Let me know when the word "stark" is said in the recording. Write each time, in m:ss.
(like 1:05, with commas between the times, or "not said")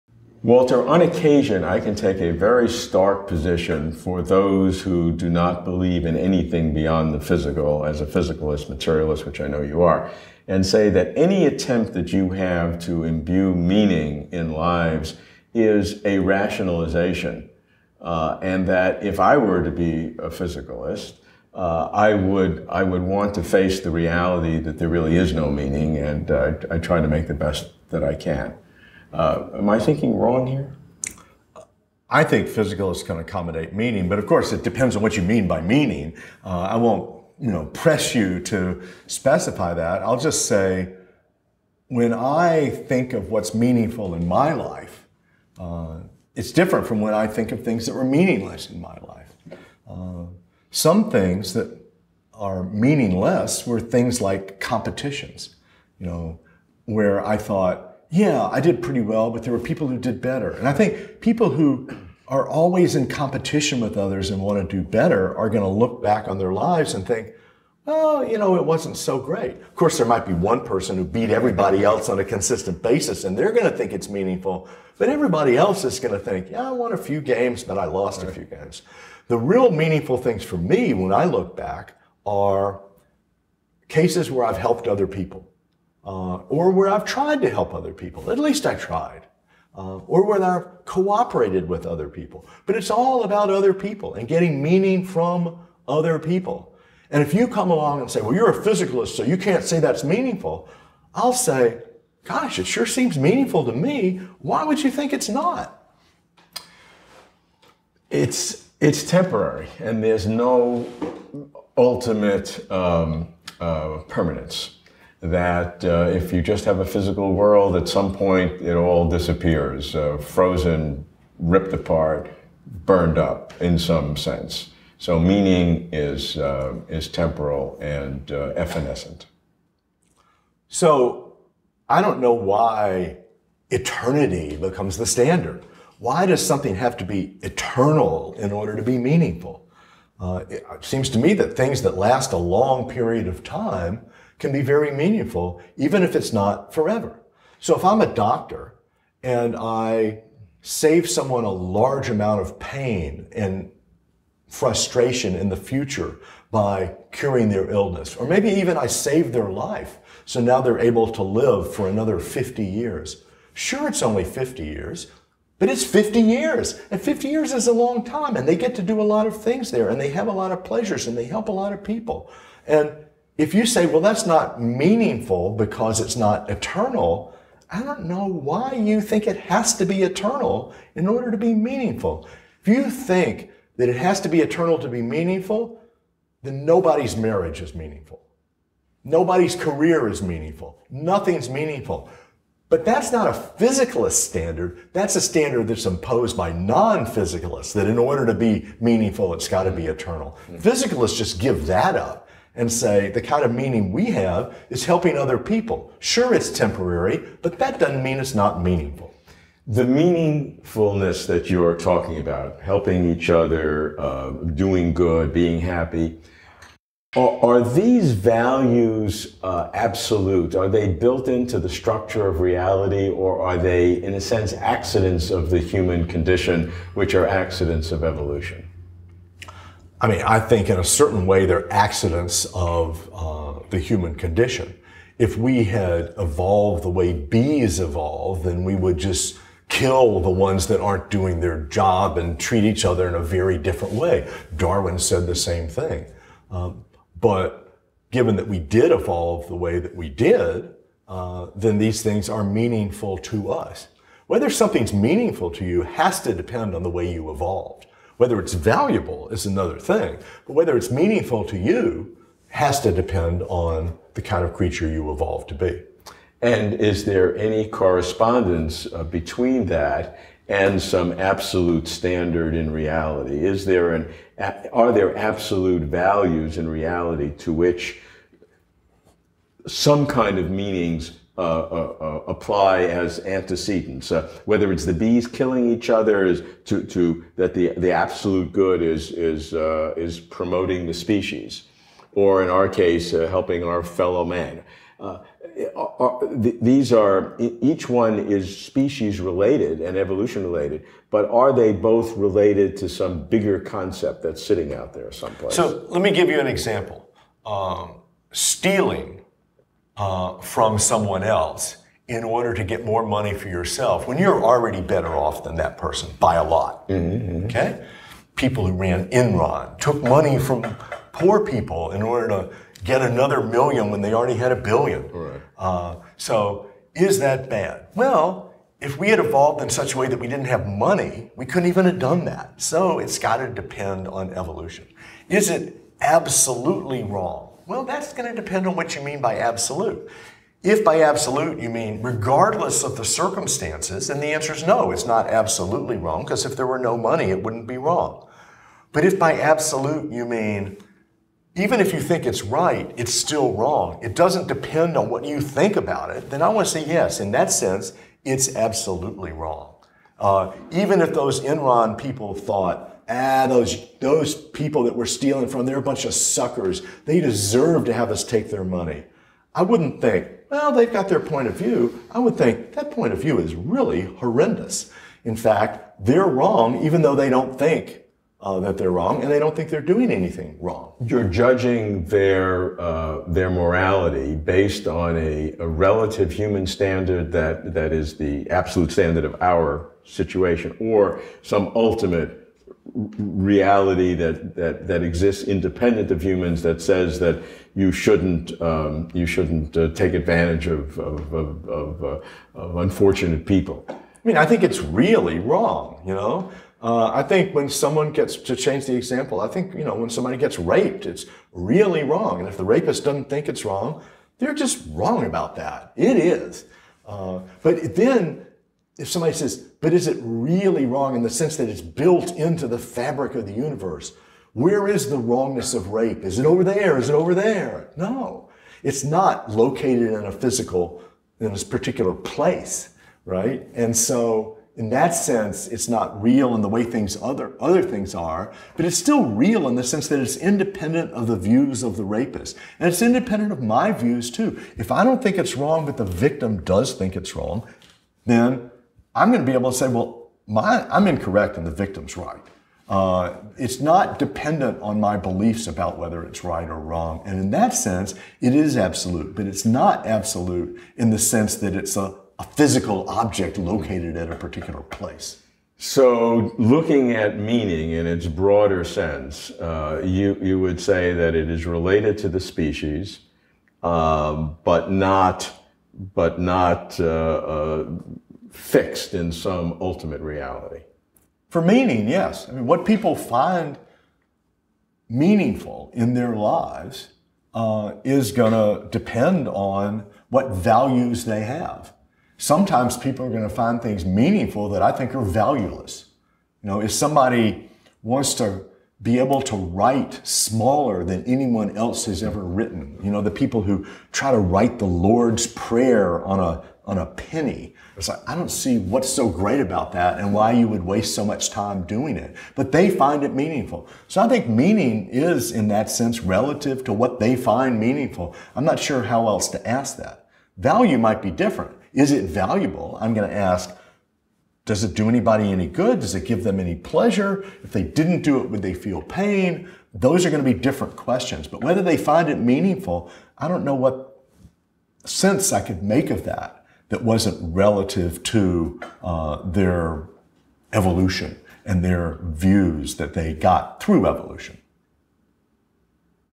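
0:02.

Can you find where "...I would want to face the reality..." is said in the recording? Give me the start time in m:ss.
0:22.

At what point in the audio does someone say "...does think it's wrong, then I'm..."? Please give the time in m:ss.
7:26.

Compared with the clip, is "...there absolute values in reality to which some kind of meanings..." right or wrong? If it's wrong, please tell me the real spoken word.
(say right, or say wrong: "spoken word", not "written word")
right.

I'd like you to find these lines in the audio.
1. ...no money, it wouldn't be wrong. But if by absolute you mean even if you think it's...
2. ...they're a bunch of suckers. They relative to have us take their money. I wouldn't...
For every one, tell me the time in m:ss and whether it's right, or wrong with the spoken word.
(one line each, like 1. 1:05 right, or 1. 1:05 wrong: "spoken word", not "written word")
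1. 5:46 right
2. 6:05 wrong: "deserve", not "relative".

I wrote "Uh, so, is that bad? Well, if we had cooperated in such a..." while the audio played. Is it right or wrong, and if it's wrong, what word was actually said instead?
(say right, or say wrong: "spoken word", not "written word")
wrong: "evolved", not "cooperated".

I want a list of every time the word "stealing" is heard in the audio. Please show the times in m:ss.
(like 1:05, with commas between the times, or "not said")
5:08, 6:05.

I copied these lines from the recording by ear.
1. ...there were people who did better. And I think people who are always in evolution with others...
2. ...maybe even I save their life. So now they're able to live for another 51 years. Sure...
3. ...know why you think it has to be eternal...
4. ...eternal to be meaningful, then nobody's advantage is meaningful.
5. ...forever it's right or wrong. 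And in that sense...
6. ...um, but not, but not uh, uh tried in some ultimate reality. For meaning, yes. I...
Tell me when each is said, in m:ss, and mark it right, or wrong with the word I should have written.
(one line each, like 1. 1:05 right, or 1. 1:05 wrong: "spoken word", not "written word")
1. 0:59 wrong: "competition", not "evolution"
2. 2:38 wrong: "50", not "51"
3. 2:58 right
4. 3:04 wrong: "marriage", not "advantage"
5. 7:35 wrong: "whether", not "forever"
6. 7:53 wrong: "fixed", not "tried".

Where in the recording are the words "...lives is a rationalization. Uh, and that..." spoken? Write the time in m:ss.
0:14.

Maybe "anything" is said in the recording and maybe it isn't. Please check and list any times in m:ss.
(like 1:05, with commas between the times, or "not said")
0:06, 6:20.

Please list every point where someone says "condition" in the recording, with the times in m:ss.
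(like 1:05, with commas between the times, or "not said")
3:46, 3:54.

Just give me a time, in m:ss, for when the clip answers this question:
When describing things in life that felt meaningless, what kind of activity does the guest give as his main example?
0:54.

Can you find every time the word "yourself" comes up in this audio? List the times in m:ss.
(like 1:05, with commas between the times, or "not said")
5:13.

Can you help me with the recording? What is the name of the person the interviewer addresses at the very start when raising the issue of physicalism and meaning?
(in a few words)
Walter.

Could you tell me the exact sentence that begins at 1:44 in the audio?
Why would you think it's not?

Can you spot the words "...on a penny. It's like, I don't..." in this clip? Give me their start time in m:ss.
8:26.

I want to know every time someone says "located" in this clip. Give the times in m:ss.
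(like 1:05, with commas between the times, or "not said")
7:09, 7:43.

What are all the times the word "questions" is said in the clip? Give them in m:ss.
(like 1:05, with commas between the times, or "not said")
8:50.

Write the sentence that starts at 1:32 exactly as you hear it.
But it's all about other people and getting meaning from other people.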